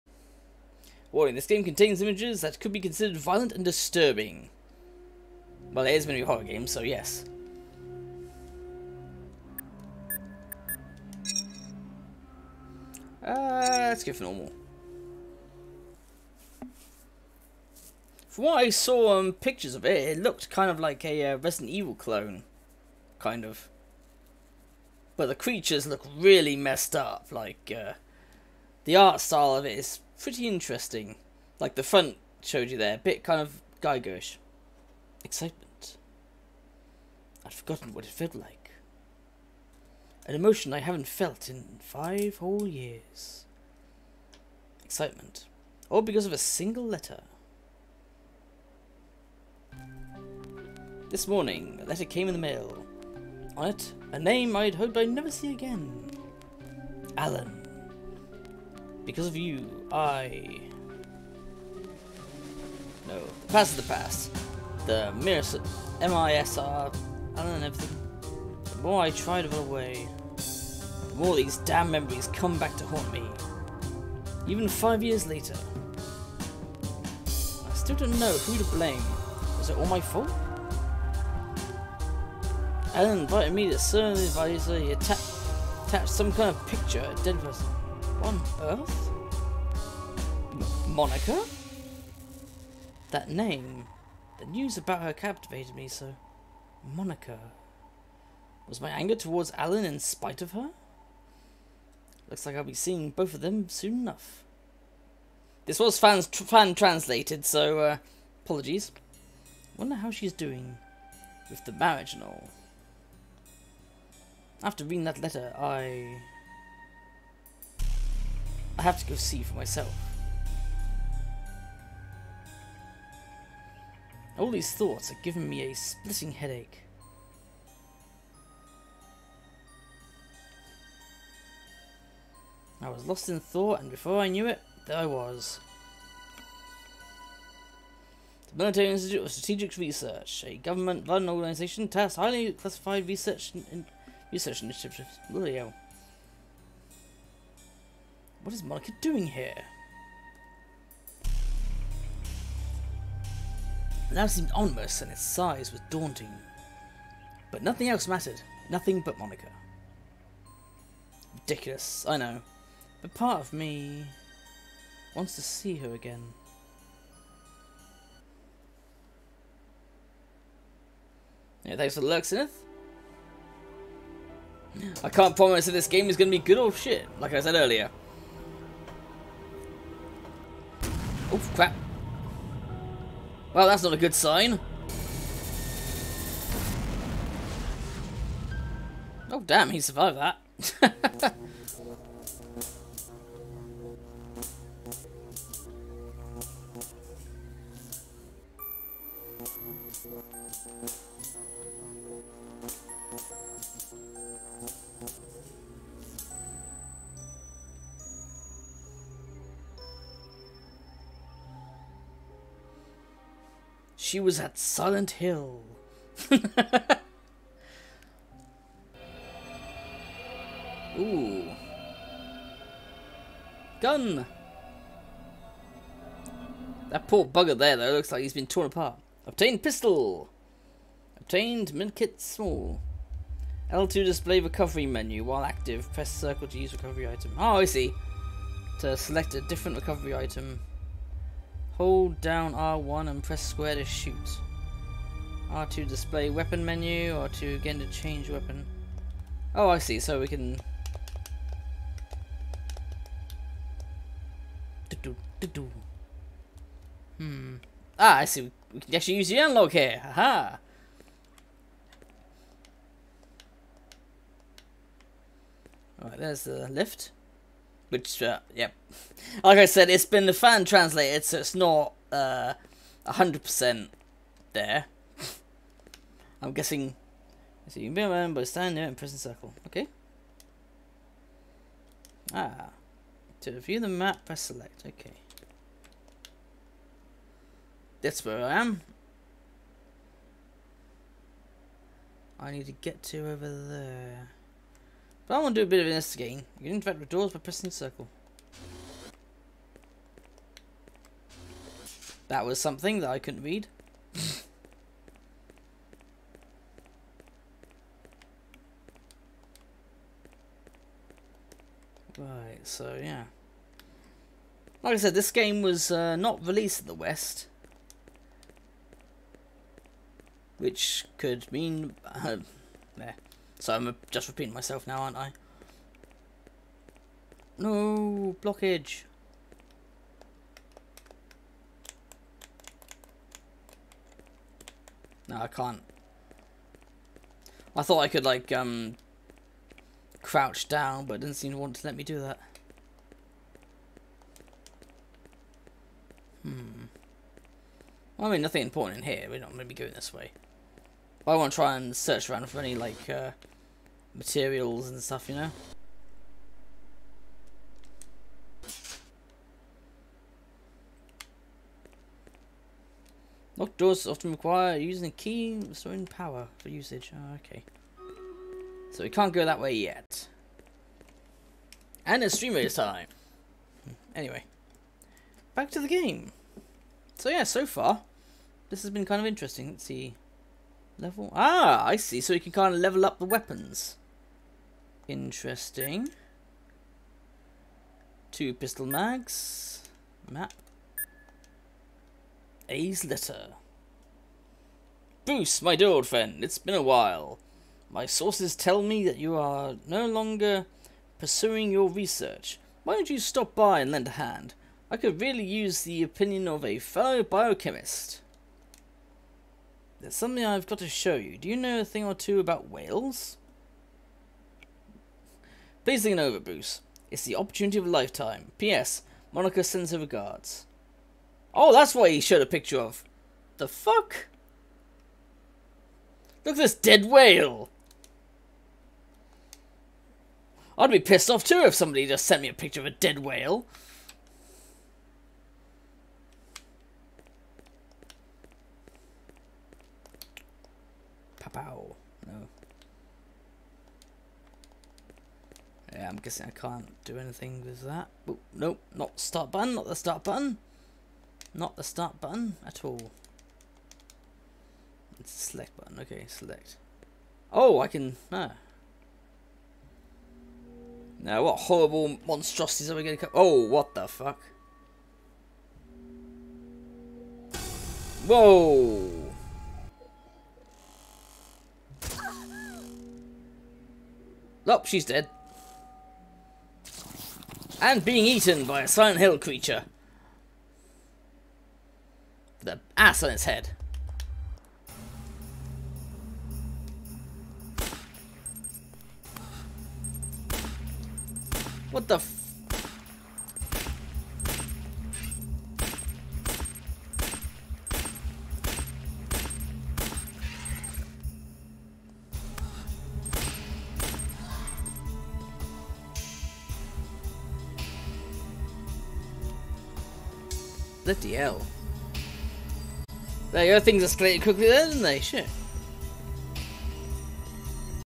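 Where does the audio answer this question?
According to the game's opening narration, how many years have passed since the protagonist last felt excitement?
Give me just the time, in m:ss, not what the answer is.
0:41.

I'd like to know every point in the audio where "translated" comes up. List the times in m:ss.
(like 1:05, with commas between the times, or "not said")
1:46, 4:30.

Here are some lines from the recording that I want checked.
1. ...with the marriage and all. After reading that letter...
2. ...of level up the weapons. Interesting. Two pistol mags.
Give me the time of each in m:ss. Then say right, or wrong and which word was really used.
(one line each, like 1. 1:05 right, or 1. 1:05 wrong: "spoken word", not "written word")
1. 1:51 right
2. 6:22 right.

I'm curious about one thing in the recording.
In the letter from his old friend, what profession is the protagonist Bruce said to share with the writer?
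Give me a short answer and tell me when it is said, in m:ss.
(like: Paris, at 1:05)
Biochemist, at 6:47.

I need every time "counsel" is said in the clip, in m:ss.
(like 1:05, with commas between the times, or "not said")
not said.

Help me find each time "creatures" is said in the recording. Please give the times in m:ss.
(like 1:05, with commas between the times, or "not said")
0:25, 7:59.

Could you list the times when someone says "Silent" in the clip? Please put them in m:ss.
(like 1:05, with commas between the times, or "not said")
3:34, 7:58.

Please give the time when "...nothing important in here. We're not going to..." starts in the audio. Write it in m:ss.
5:48.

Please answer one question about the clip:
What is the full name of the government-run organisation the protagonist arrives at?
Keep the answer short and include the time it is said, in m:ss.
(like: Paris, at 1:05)
The Military Institute of Strategic Research, at 2:18.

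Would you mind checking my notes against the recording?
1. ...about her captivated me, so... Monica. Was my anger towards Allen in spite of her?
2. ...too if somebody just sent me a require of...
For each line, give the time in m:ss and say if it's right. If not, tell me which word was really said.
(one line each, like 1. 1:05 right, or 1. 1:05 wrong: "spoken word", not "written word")
1. 1:34 right
2. 7:11 wrong: "picture", not "require".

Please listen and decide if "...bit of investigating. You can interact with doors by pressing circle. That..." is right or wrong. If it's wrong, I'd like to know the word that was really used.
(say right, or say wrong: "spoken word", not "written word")
right.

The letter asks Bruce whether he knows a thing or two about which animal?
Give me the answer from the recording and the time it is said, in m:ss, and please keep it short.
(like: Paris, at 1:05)
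Whales, at 6:52.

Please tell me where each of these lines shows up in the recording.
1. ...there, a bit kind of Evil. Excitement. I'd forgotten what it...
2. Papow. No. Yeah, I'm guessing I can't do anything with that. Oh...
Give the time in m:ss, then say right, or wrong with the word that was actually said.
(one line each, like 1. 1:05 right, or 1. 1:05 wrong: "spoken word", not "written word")
1. 0:32 wrong: "Gigerish", not "Evil"
2. 7:21 right.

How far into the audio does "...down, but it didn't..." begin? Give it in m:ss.
5:40.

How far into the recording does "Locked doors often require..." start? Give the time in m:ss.
6:03.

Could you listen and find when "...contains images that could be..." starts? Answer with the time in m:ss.
0:01.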